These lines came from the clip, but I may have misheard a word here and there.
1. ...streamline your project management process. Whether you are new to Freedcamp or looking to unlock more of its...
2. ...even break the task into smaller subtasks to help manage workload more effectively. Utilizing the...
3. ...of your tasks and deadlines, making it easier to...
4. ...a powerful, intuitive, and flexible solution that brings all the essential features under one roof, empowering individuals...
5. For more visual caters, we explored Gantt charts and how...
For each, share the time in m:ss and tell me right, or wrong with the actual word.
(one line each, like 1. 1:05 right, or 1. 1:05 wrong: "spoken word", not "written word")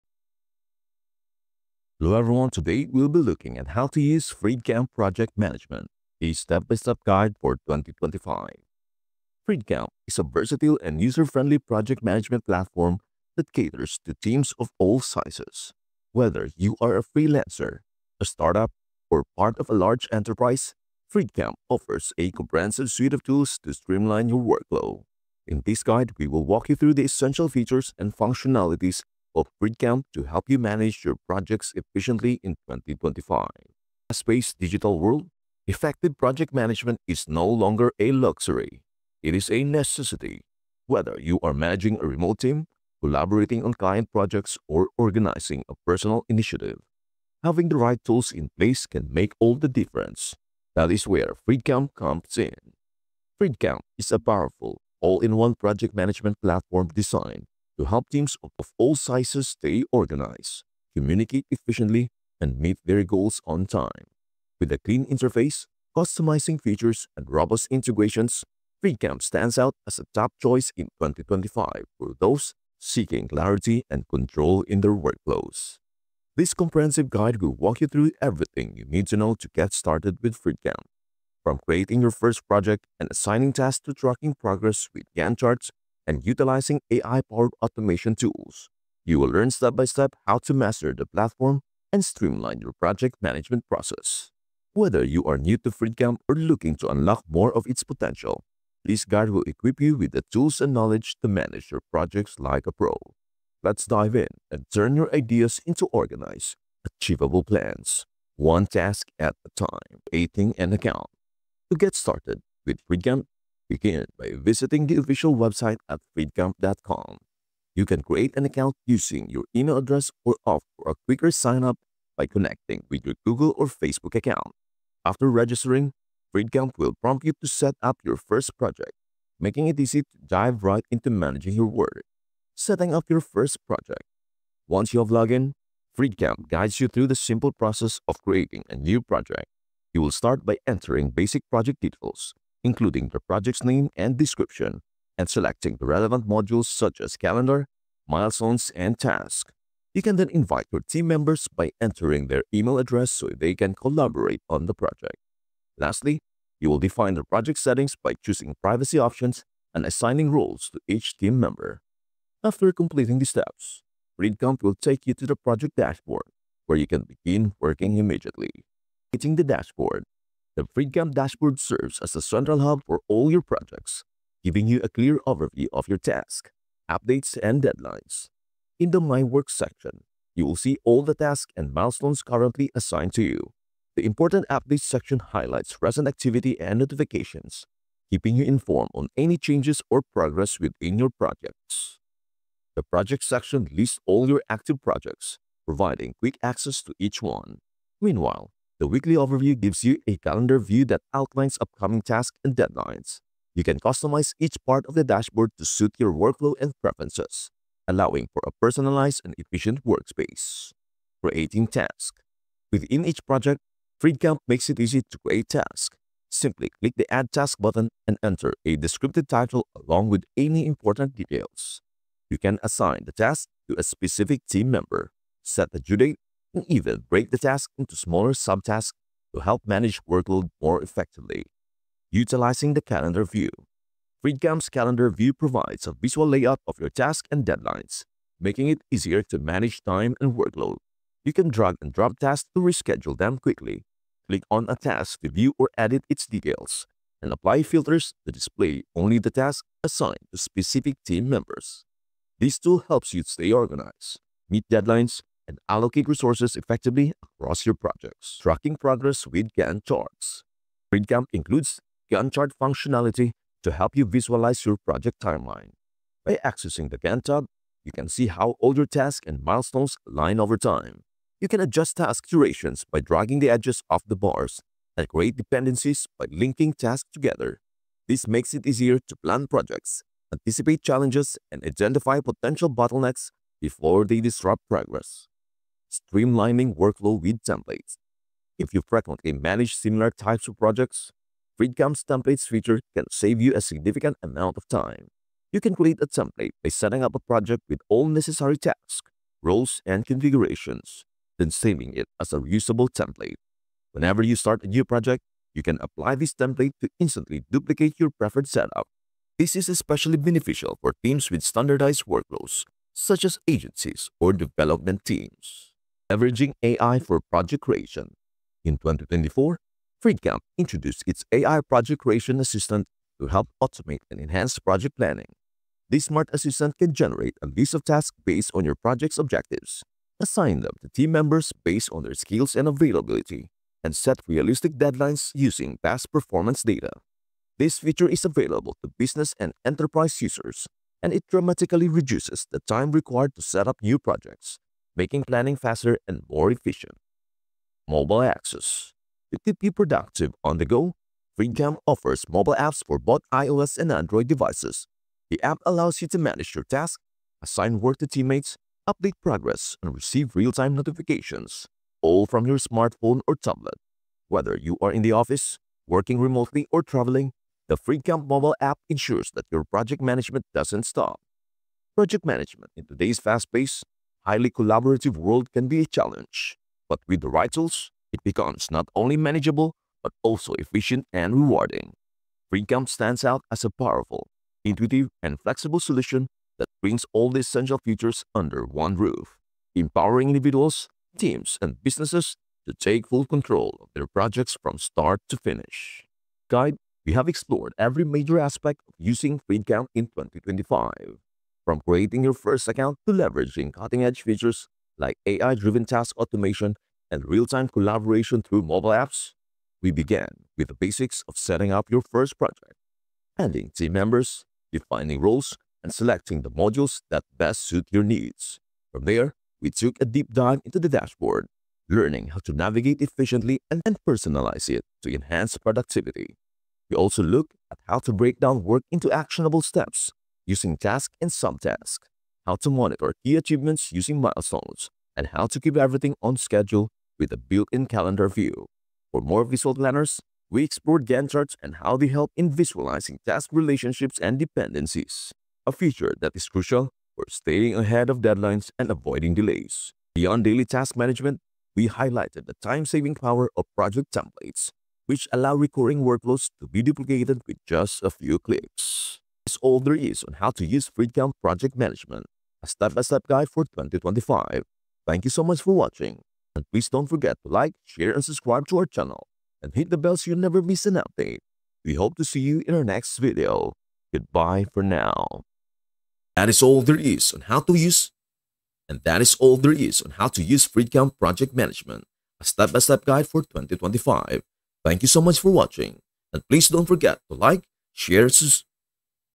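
1. 1:32 right
2. 3:46 right
3. 3:56 right
4. 6:23 right
5. 7:19 wrong: "planners", not "caters".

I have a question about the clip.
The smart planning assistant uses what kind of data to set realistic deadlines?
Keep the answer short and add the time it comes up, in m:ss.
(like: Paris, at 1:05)
past performance data, at 5:35.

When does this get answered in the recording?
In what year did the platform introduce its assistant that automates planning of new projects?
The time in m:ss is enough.
5:18.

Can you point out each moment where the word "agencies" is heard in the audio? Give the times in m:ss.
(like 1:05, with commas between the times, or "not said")
5:13.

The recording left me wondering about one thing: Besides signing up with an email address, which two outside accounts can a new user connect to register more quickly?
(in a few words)
Google or Facebook.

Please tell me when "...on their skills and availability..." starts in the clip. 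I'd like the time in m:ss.
5:31.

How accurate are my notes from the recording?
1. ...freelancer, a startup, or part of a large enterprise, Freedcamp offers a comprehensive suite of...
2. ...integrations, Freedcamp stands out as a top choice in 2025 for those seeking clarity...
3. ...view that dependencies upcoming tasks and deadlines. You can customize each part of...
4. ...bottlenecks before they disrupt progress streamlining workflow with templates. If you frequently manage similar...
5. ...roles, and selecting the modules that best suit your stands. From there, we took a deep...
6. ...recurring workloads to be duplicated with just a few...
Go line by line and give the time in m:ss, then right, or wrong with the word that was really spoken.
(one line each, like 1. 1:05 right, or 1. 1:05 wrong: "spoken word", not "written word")
1. 0:17 right
2. 1:07 right
3. 3:20 wrong: "outlines", not "dependencies"
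4. 4:42 right
5. 6:55 wrong: "needs", not "stands"
6. 7:35 right.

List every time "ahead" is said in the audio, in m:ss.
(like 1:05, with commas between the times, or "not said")
7:27.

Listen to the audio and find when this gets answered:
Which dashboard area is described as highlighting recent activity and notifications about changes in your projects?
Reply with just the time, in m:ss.
3:04.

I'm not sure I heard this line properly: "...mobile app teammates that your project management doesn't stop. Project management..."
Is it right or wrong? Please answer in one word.
wrong.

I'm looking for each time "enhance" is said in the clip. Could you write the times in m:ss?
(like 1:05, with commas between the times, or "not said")
5:24, 7:05.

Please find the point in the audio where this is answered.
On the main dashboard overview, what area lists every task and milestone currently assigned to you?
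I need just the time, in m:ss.
2:58.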